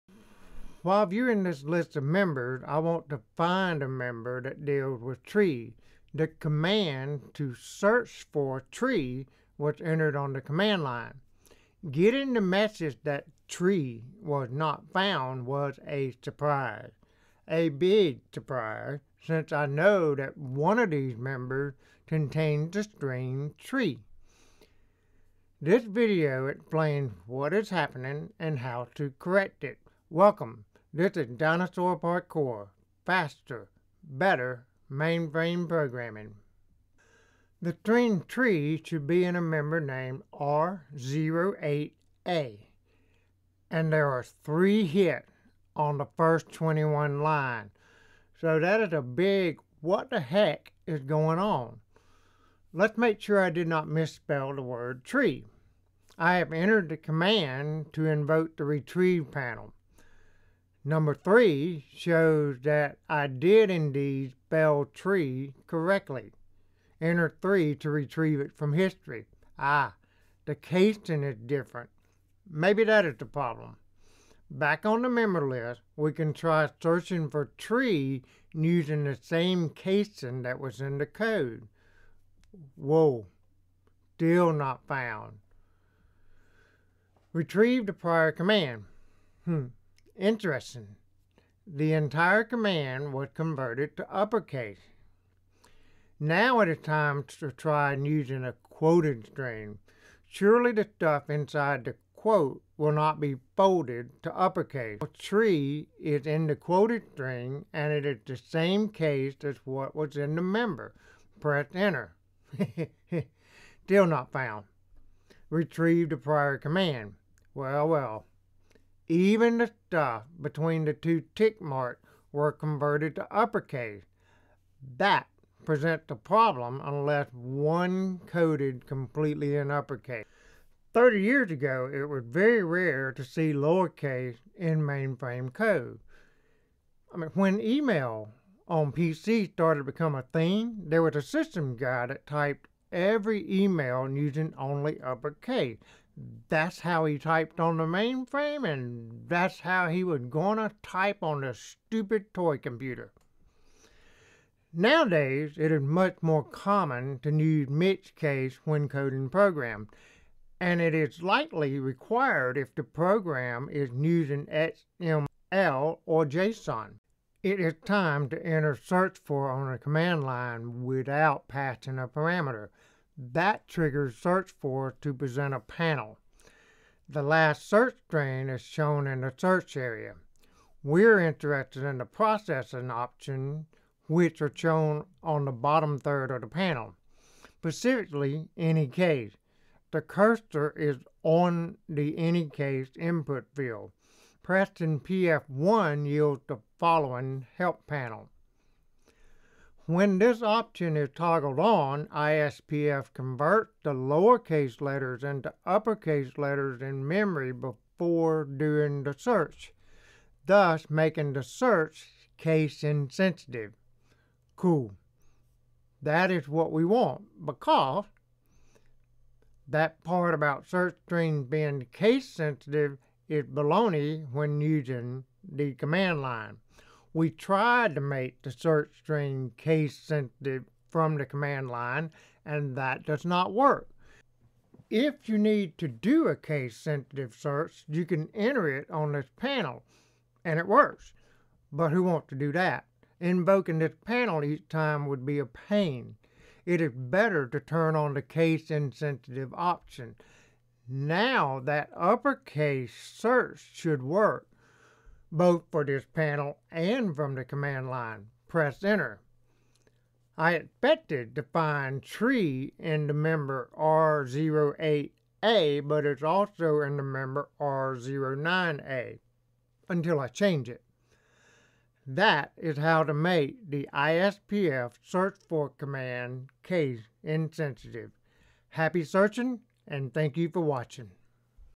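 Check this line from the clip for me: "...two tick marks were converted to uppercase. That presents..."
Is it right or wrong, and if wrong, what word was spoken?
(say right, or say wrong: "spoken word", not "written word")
right.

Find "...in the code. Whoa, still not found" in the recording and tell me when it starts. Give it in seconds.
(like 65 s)
80 s.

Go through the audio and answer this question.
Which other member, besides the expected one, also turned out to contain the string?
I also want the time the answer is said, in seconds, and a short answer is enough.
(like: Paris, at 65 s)
R09A, at 267 s.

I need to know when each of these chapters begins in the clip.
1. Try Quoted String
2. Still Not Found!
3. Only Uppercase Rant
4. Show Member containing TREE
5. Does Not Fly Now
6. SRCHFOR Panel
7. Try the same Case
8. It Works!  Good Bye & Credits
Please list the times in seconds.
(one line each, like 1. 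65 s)
1. 88 s
2. 112 s
3. 130 s
4. 36 s
5. 153 s
6. 166 s
7. 74 s
8. 260 s.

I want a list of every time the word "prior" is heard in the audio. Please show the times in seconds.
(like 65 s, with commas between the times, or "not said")
87 s, 116 s.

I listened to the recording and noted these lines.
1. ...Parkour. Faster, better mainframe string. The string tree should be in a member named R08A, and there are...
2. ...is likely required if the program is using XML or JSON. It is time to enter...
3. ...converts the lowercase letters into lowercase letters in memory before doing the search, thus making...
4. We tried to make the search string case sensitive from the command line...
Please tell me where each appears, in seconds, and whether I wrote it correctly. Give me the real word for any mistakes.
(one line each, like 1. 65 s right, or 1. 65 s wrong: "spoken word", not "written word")
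1. 31 s wrong: "programming", not "string"
2. 160 s right
3. 203 s wrong: "uppercase", not "lowercase"
4. 227 s right.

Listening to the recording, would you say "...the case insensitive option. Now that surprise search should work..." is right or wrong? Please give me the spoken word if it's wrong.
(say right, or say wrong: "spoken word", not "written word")
wrong: "uppercase", not "surprise".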